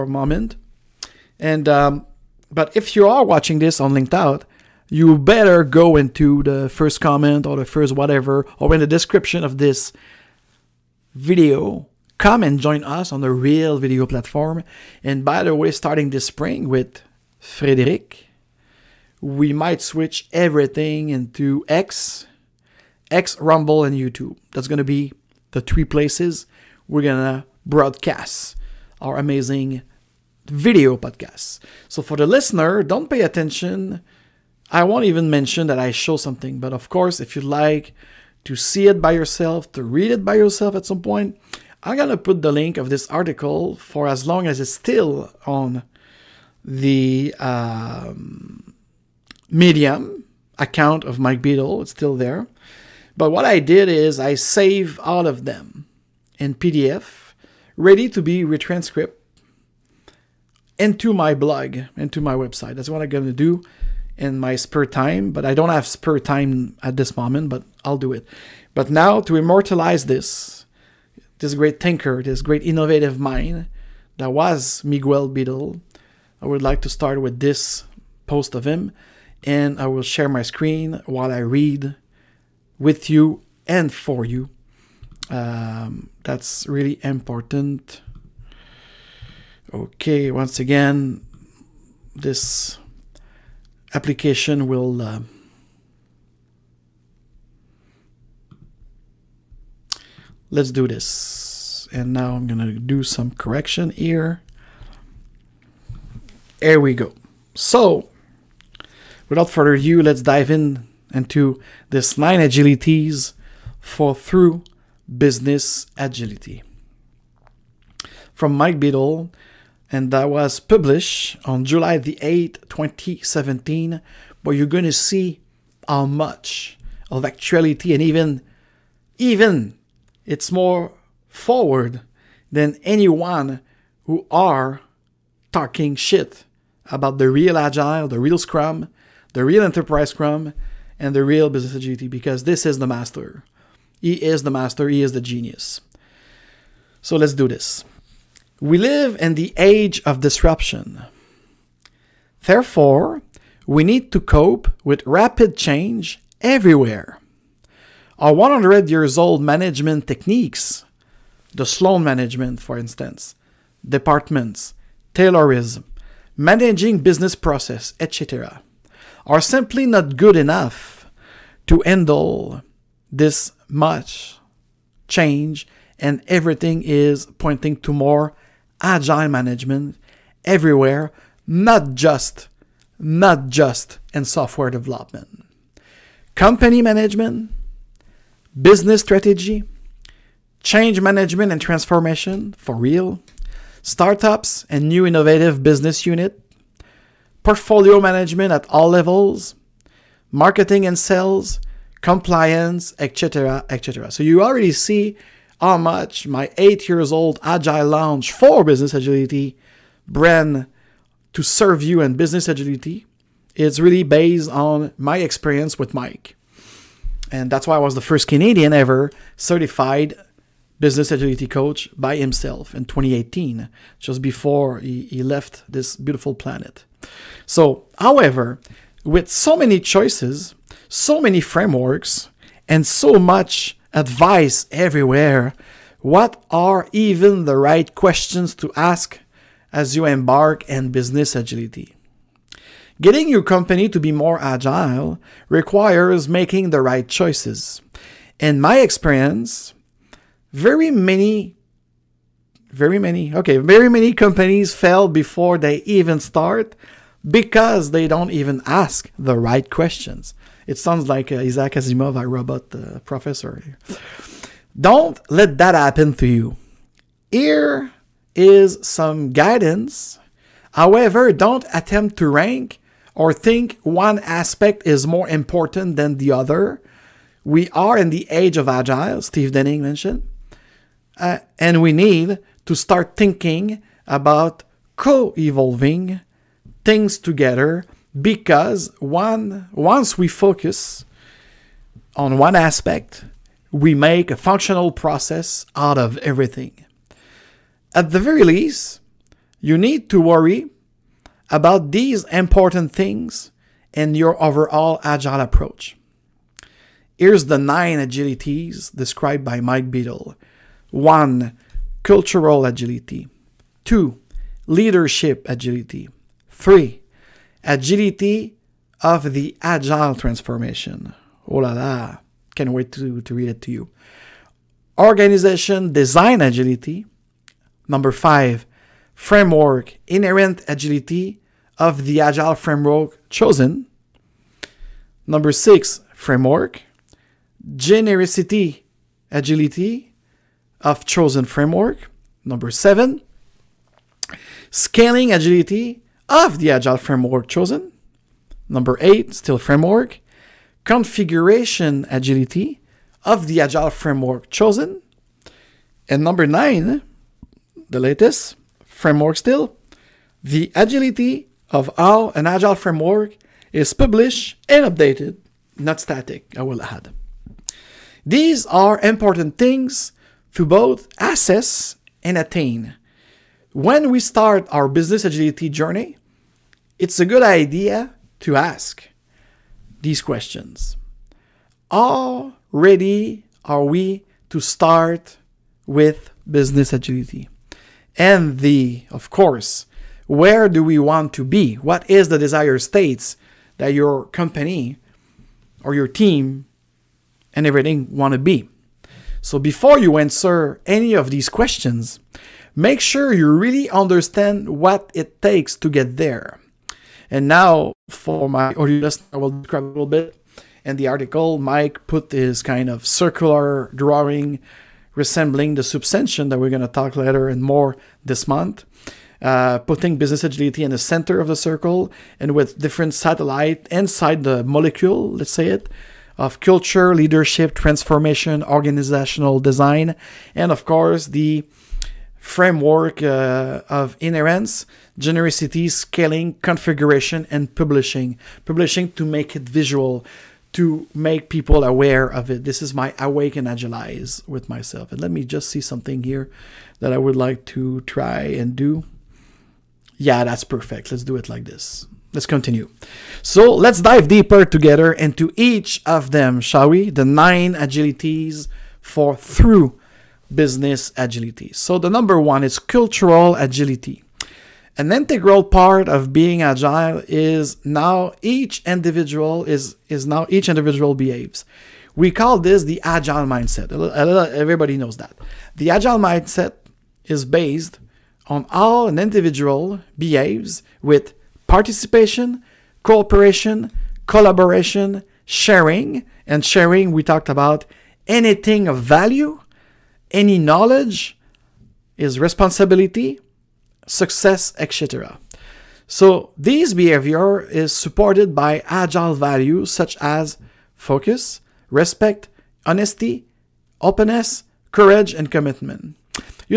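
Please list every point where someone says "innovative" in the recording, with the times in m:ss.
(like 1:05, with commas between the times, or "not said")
1:12, 3:15.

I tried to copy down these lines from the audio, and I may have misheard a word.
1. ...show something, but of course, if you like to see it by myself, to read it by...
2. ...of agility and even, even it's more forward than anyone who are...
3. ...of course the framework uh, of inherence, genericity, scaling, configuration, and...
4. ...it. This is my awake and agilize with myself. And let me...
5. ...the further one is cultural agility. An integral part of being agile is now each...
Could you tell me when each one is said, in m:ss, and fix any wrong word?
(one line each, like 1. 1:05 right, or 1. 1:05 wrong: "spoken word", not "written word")
1. 0:35 wrong: "yourself", not "myself"
2. 2:07 wrong: "actuality", not "agility"
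3. 7:10 right
4. 7:22 right
5. 7:41 wrong: "number", not "further".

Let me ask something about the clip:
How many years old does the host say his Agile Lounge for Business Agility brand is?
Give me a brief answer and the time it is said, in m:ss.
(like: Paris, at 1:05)
8, at 3:26.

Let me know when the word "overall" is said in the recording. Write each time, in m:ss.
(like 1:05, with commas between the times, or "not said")
5:04.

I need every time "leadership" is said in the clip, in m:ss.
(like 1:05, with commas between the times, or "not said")
5:14, 7:07.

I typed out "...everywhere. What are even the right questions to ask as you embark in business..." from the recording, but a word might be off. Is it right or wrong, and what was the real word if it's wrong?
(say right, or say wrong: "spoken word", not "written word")
right.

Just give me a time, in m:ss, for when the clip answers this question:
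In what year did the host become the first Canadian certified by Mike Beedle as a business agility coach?
3:42.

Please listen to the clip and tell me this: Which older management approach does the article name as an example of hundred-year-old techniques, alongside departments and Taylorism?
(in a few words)
Sloan management.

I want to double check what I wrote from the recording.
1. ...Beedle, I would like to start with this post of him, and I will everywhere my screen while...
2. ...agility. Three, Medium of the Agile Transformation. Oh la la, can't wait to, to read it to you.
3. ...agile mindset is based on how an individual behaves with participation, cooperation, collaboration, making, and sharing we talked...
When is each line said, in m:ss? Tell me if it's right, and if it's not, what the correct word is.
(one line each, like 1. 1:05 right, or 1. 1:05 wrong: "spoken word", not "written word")
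1. 1:15 wrong: "share", not "everywhere"
2. 5:15 wrong: "Agility", not "Medium"
3. 7:55 wrong: "sharing", not "making".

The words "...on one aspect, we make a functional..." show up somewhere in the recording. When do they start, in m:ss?
4:52.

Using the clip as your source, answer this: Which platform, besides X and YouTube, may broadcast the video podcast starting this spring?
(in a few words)
Rumble.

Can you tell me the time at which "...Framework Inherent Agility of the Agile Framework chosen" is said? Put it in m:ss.
5:29.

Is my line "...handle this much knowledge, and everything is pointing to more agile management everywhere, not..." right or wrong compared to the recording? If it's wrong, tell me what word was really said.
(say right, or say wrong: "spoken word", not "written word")
wrong: "change", not "knowledge".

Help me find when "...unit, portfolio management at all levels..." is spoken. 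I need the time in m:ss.
3:16.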